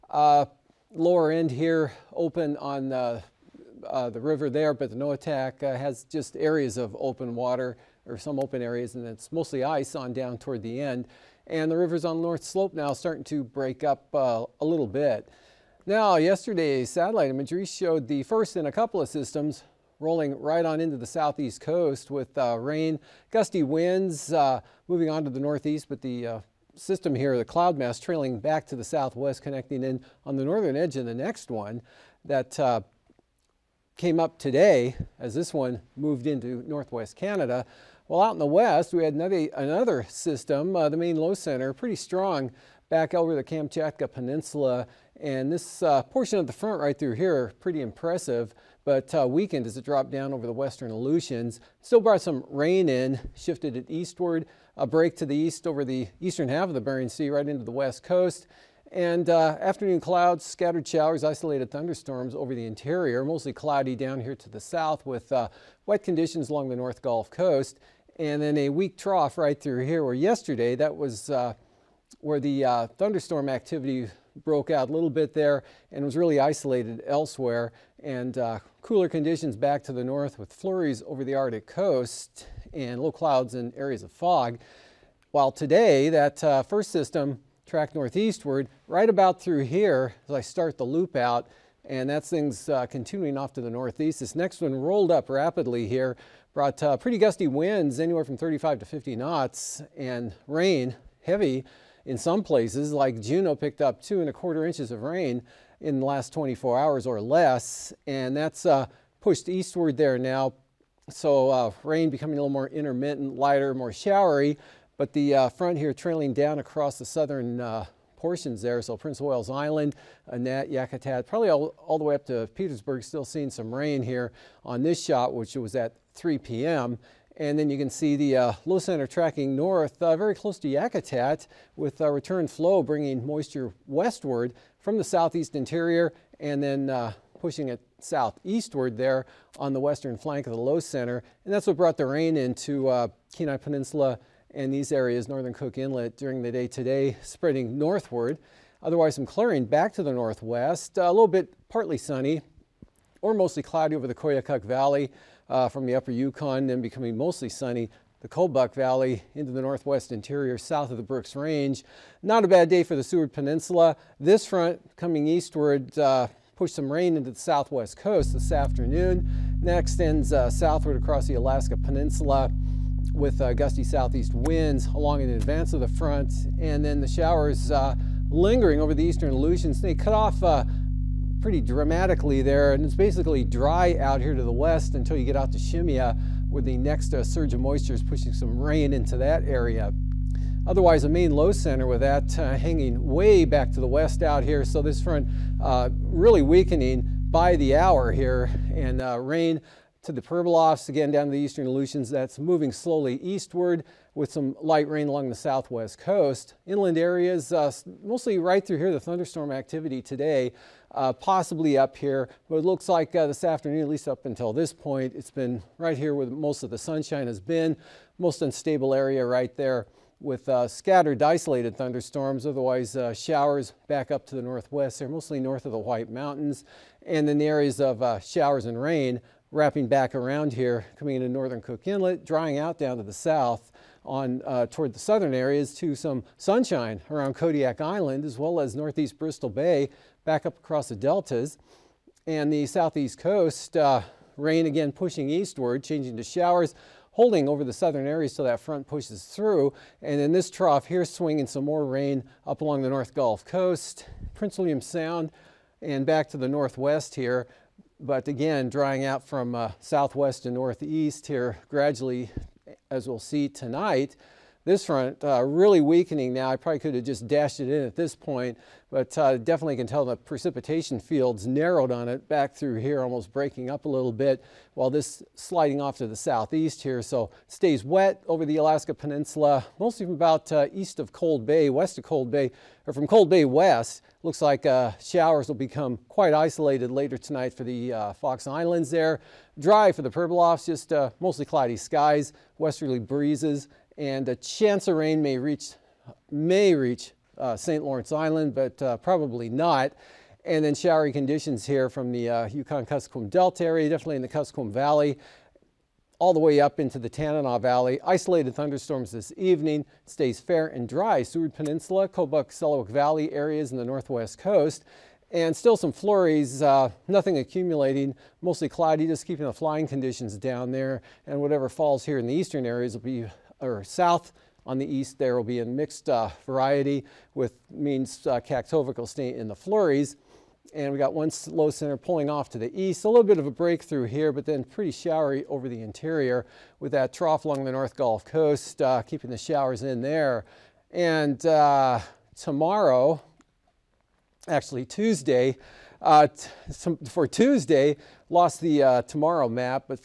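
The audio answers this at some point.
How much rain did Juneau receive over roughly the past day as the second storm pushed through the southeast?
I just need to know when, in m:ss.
1:44.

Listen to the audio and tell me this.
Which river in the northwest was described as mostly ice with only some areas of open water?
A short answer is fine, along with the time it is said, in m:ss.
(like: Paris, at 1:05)
Noatak, at 0:04.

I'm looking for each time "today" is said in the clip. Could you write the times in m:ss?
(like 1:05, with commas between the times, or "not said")
0:34, 1:25, 2:26, 3:30.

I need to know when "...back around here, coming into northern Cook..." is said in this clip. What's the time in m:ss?
3:49.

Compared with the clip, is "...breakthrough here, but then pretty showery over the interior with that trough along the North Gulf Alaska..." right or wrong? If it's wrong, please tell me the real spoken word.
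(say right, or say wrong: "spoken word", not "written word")
wrong: "Coast", not "Alaska".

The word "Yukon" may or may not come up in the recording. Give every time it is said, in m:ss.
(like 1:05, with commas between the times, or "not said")
2:36, 5:02.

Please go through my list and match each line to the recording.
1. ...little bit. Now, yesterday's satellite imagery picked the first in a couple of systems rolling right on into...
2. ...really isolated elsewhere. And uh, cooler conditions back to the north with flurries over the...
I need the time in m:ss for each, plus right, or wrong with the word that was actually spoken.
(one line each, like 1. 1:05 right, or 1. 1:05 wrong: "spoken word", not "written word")
1. 0:14 wrong: "showed", not "picked"
2. 1:16 right.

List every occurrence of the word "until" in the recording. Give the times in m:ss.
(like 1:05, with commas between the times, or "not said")
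3:04, 3:34.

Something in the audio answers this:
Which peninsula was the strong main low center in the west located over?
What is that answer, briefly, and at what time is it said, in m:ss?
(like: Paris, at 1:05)
Kamchatka Peninsula, at 0:43.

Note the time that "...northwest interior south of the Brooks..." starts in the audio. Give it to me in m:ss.
2:39.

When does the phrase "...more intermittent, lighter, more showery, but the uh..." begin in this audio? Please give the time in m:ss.
1:52.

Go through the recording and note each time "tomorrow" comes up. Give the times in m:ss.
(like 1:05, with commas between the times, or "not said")
5:42, 5:49.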